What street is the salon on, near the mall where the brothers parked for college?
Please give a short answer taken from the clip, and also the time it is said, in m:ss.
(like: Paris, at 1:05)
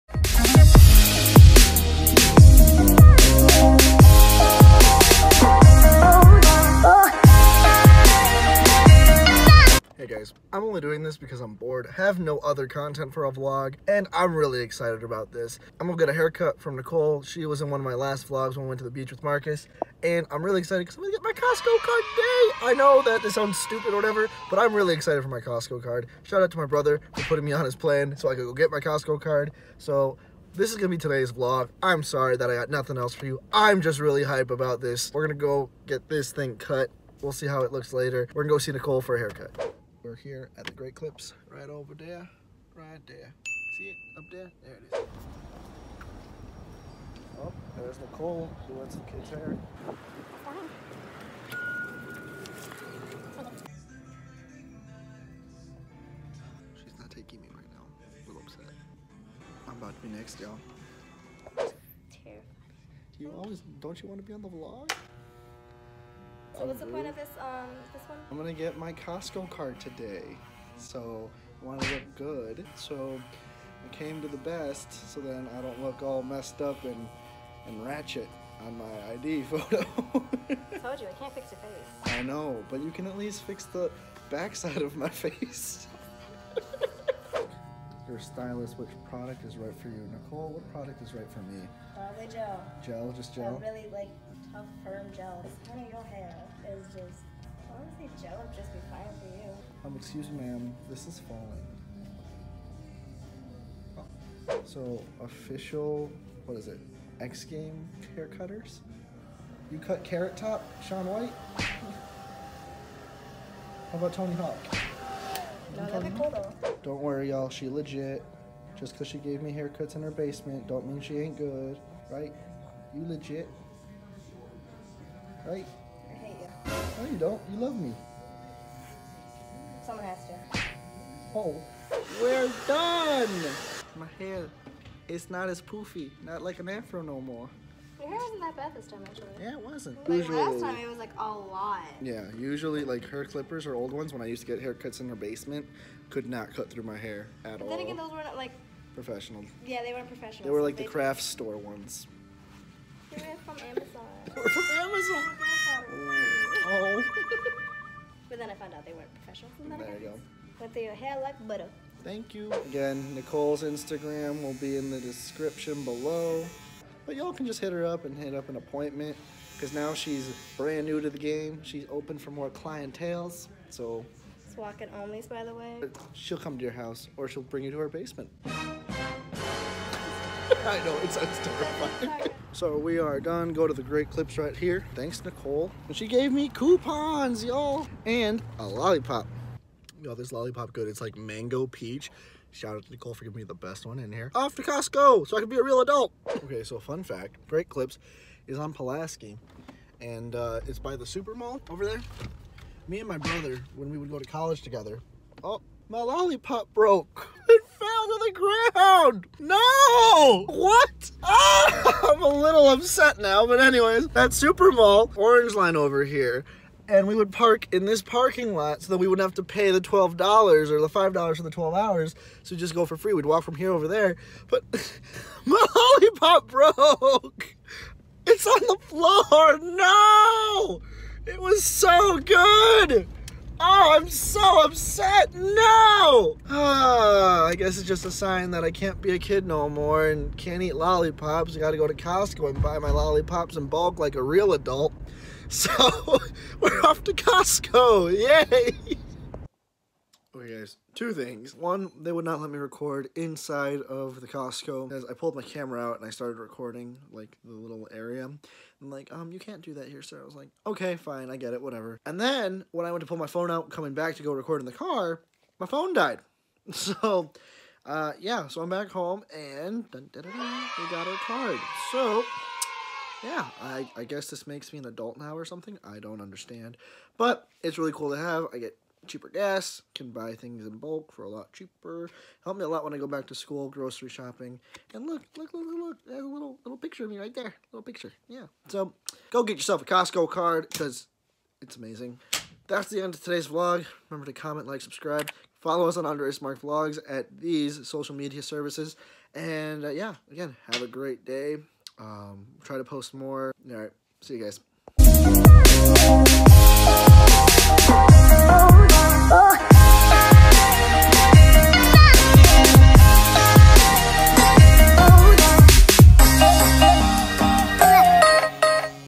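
Pulaski, at 3:18.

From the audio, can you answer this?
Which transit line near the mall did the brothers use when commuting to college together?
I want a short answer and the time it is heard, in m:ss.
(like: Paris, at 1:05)
Orange Line, at 3:35.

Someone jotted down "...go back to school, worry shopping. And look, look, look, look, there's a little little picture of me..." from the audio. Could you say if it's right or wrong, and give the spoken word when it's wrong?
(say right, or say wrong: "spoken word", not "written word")
wrong: "grocery", not "worry".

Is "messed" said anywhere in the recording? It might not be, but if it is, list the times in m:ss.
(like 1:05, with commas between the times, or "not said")
1:16.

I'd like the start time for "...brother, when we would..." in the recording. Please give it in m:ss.
3:23.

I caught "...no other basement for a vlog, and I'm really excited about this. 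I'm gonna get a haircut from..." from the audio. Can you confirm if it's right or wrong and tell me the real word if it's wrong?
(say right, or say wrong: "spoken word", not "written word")
wrong: "content", not "basement".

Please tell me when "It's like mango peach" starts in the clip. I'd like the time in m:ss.
3:10.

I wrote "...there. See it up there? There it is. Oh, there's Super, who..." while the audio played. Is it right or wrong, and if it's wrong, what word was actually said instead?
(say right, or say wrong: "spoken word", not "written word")
wrong: "Nicole", not "Super".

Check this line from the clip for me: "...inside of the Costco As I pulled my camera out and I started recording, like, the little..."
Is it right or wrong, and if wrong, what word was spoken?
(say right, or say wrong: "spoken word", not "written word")
right.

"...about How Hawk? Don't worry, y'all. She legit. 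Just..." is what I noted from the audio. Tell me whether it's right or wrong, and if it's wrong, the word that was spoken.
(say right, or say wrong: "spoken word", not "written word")
wrong: "Tony", not "How".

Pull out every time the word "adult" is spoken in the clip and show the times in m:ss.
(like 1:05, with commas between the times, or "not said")
3:15, 4:04, 4:34.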